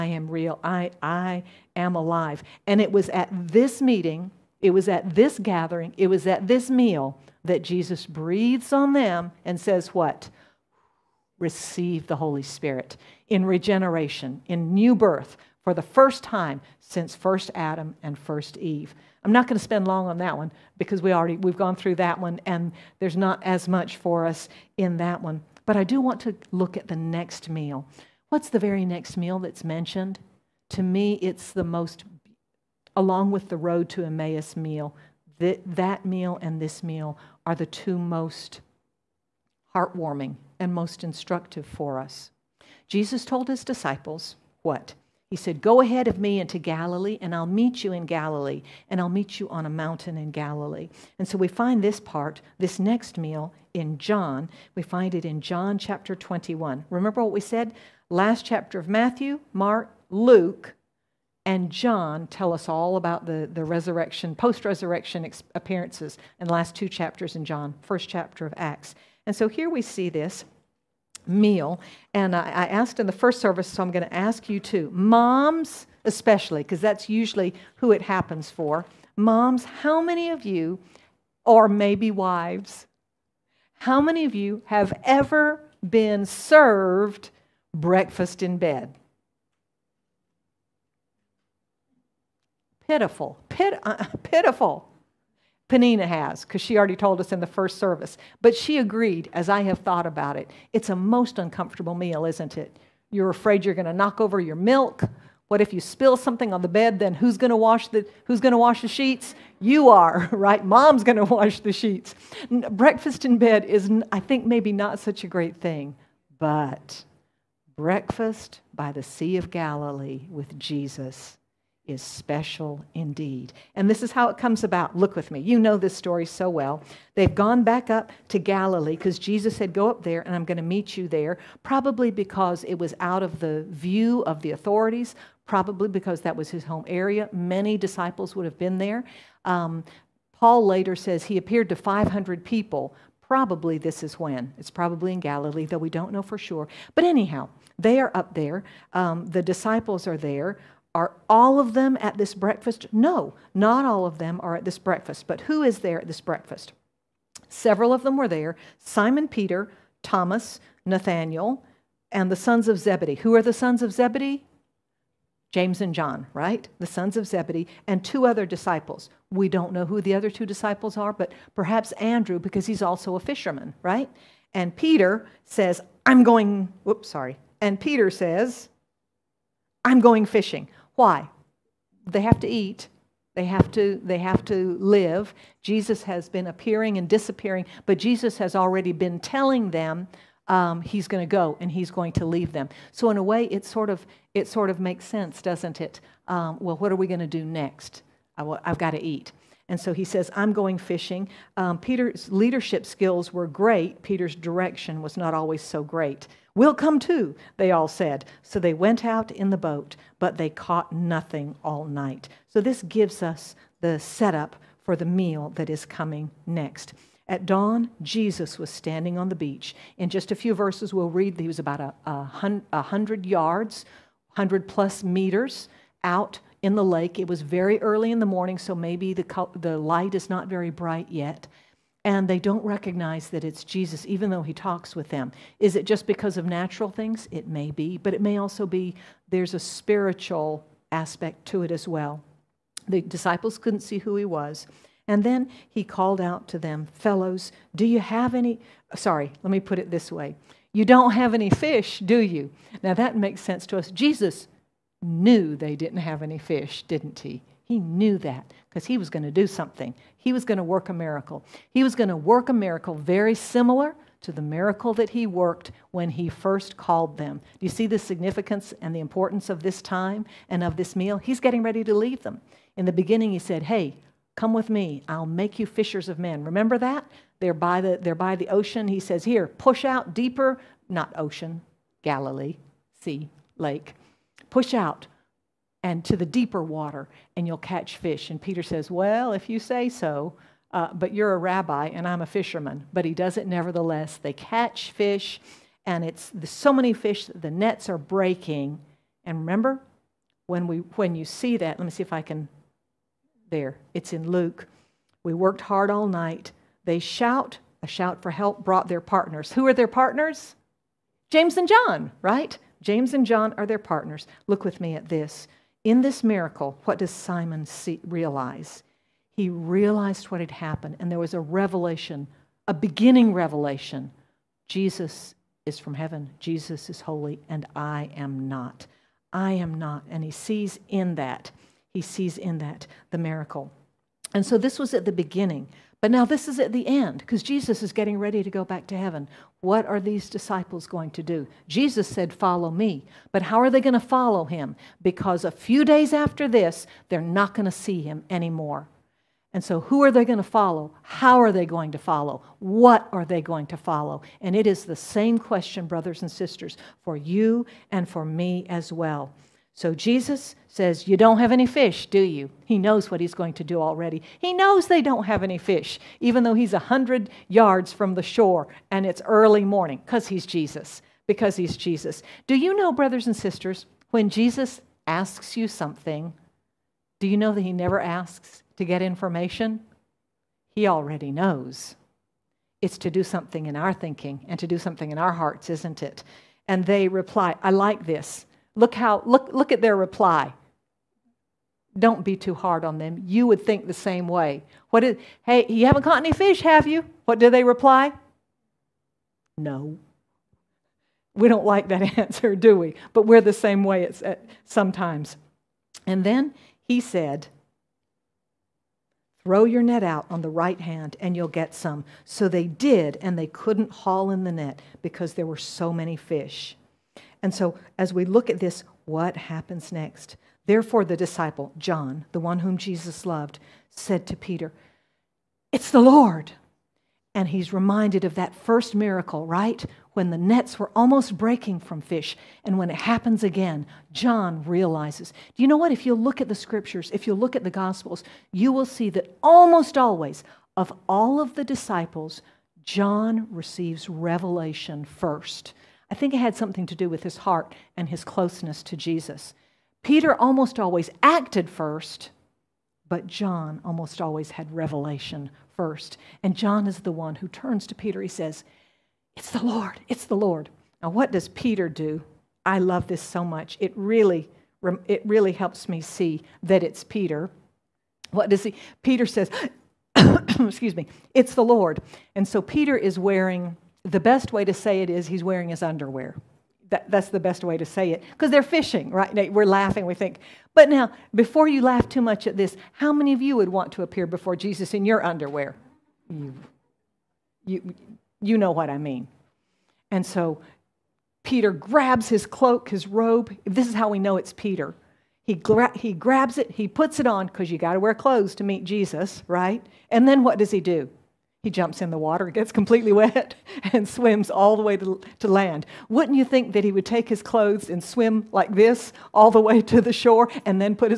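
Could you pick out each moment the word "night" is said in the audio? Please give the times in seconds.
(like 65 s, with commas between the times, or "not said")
211 s, 306 s.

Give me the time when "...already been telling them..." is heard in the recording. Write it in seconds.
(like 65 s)
188 s.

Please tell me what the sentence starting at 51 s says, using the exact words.
And so we find this part, this next meal, in John.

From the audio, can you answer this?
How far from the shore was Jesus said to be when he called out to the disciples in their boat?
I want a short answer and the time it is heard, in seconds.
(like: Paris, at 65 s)
100 yards, at 222 s.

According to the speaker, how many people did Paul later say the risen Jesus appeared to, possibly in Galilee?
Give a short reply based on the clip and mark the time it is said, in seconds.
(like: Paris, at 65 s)
500, at 141 s.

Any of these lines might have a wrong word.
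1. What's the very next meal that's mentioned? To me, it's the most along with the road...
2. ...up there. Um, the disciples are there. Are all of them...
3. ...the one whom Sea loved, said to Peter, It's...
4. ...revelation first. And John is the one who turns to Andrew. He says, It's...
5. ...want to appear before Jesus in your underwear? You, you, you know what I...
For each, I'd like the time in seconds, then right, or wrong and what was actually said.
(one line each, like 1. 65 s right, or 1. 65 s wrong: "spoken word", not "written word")
1. 28 s right
2. 148 s right
3. 422 s wrong: "Jesus", not "Sea"
4. 454 s wrong: "Peter", not "Andrew"
5. 483 s right.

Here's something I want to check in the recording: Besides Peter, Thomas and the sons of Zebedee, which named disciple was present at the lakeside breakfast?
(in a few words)
Nathaniel.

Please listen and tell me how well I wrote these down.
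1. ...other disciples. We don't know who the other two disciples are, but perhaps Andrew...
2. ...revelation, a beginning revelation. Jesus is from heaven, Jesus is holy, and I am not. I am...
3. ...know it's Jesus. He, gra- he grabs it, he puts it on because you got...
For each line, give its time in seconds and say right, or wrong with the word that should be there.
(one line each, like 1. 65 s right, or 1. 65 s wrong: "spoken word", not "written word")
1. 168 s right
2. 321 s right
3. 494 s wrong: "Peter", not "Jesus".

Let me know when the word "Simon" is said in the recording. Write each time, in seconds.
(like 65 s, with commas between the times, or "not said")
158 s, 317 s.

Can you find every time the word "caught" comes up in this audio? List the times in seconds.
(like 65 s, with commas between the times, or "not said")
210 s, 396 s.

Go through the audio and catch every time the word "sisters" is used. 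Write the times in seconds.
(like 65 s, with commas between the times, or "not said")
356 s, 373 s.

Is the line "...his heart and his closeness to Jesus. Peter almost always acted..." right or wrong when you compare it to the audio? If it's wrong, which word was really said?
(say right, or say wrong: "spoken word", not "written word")
right.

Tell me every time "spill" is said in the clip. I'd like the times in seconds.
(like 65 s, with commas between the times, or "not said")
105 s.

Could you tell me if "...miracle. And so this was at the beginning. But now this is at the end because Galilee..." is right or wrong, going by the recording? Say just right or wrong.
wrong.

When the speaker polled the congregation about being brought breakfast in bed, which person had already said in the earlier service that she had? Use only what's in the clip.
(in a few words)
Panina.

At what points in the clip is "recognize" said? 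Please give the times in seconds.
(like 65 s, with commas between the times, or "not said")
232 s.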